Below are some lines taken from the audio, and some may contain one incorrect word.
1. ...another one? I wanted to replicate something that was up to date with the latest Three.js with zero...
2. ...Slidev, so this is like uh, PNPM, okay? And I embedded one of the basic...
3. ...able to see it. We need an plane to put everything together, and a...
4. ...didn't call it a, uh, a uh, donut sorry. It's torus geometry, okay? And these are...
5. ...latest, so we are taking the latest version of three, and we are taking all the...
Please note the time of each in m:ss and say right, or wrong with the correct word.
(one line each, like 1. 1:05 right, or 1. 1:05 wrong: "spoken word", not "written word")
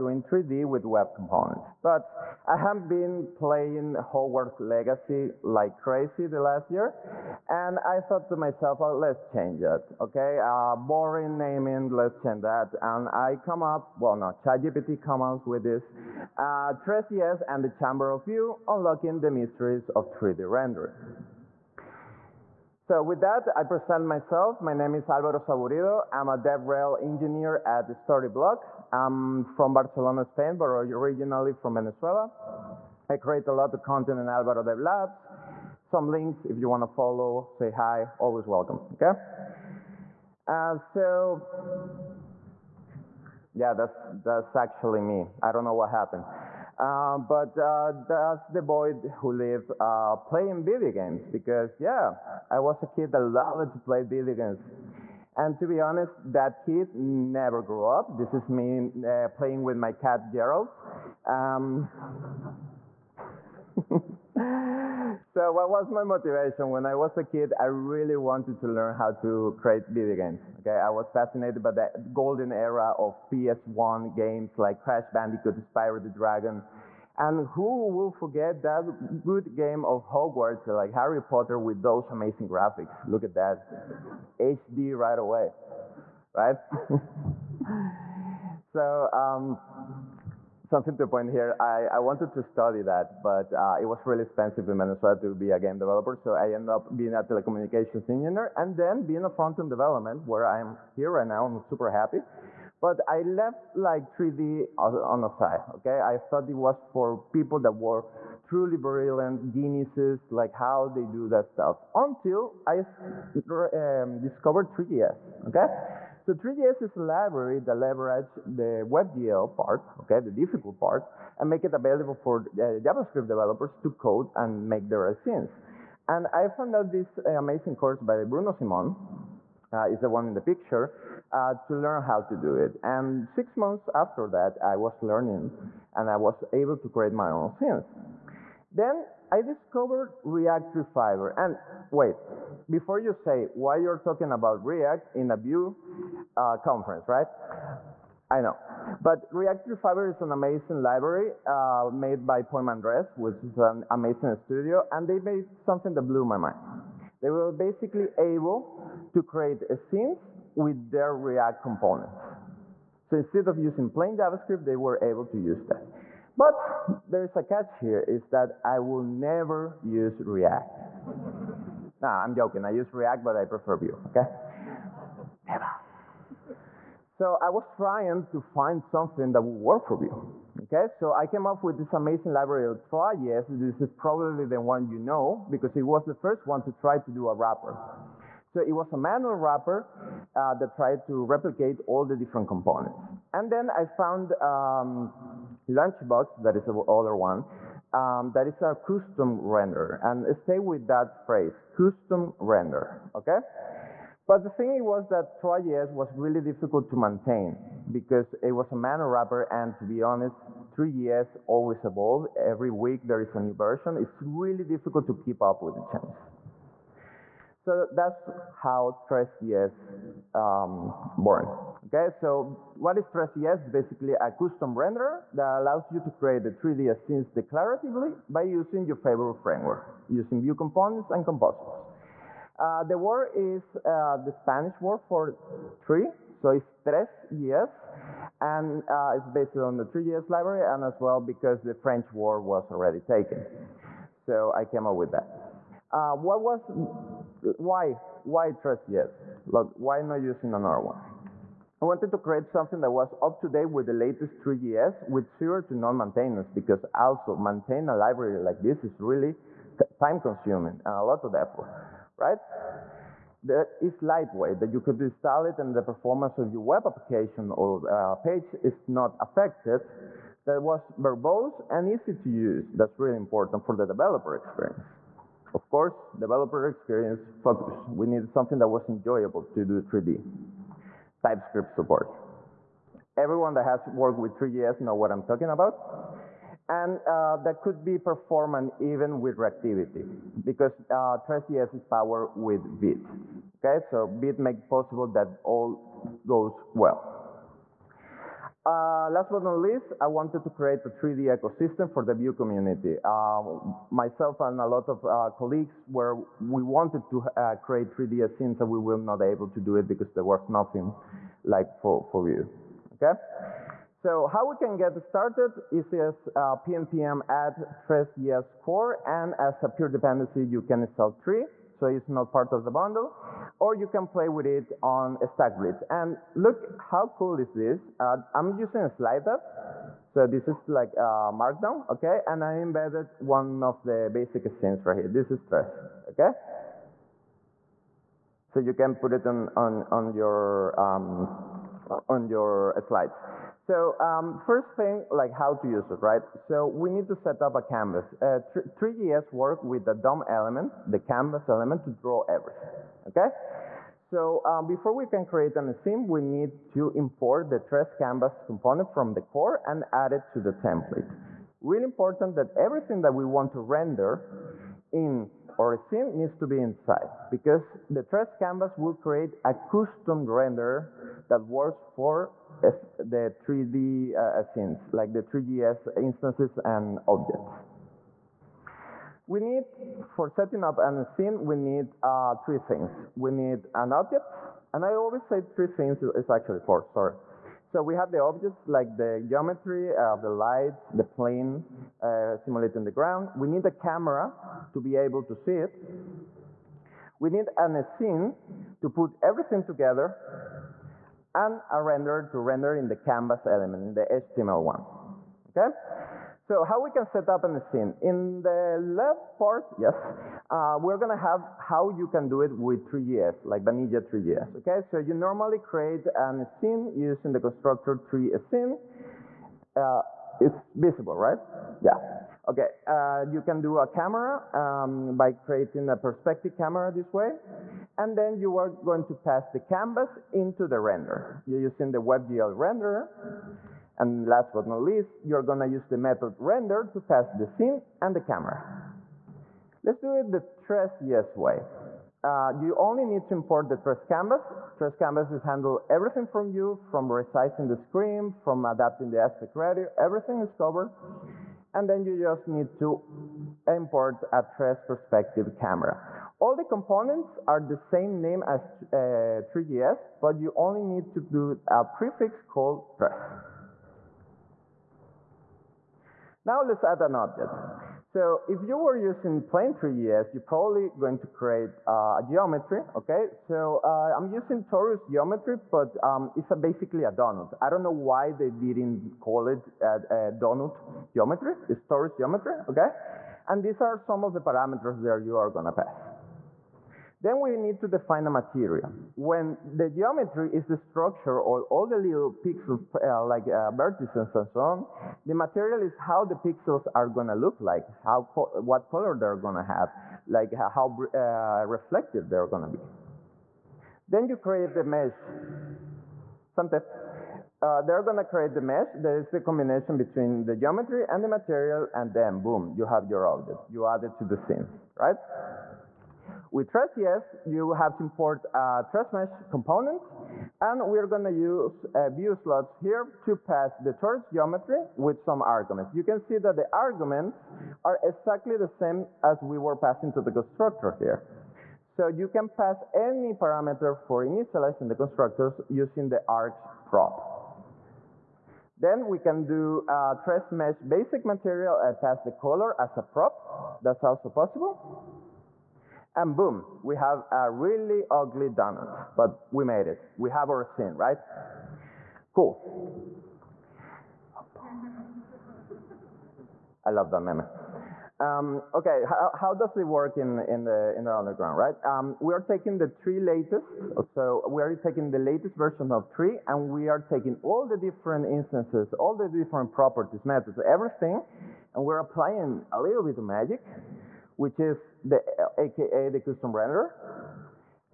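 1. 4:10 wrong: "create", not "replicate"
2. 5:28 wrong: "Markdown", not "PNPM"
3. 6:34 wrong: "scene", not "plane"
4. 7:58 wrong: "geometry", not "sorry"
5. 9:23 right.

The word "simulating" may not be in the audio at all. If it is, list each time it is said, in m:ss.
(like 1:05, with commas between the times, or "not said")
6:32.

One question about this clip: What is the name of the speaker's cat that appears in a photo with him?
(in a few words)
Gerald.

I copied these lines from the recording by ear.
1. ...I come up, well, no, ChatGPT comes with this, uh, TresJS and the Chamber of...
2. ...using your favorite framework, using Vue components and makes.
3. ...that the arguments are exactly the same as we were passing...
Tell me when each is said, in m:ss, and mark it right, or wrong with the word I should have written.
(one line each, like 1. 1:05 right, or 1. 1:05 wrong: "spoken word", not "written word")
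1. 0:13 right
2. 3:48 wrong: "composables", not "makes"
3. 8:46 right.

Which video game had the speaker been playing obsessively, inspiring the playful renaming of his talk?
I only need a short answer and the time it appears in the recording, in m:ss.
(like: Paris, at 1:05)
Hogwarts Legacy, at 0:03.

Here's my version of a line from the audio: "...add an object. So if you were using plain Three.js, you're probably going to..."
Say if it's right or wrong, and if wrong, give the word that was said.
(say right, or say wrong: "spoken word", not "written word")
right.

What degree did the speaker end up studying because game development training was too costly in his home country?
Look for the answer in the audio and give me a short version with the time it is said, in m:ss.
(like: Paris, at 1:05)
telecommunications engineer, at 1:37.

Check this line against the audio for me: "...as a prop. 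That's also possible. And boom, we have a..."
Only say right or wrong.
right.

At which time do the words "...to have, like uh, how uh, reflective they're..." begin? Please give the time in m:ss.
8:19.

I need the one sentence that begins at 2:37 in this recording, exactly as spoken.
They were basically able to create scenes with their React components.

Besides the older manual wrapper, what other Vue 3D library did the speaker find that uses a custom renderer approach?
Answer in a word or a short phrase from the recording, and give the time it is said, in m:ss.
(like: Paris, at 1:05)
Lunchbox, at 3:15.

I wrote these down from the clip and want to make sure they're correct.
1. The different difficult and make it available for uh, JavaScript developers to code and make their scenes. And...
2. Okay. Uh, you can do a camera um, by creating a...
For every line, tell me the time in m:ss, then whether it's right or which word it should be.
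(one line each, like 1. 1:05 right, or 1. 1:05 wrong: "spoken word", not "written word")
1. 2:00 right
2. 7:02 right.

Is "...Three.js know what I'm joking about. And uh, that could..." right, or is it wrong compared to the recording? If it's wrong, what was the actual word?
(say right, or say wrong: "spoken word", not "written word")
wrong: "talking", not "joking".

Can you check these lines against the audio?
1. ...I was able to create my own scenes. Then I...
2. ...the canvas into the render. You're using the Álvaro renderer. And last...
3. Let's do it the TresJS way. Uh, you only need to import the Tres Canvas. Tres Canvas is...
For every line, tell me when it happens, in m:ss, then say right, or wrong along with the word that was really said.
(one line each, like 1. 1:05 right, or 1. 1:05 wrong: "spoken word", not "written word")
1. 2:16 right
2. 7:09 wrong: "WebGL", not "Álvaro"
3. 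7:19 right.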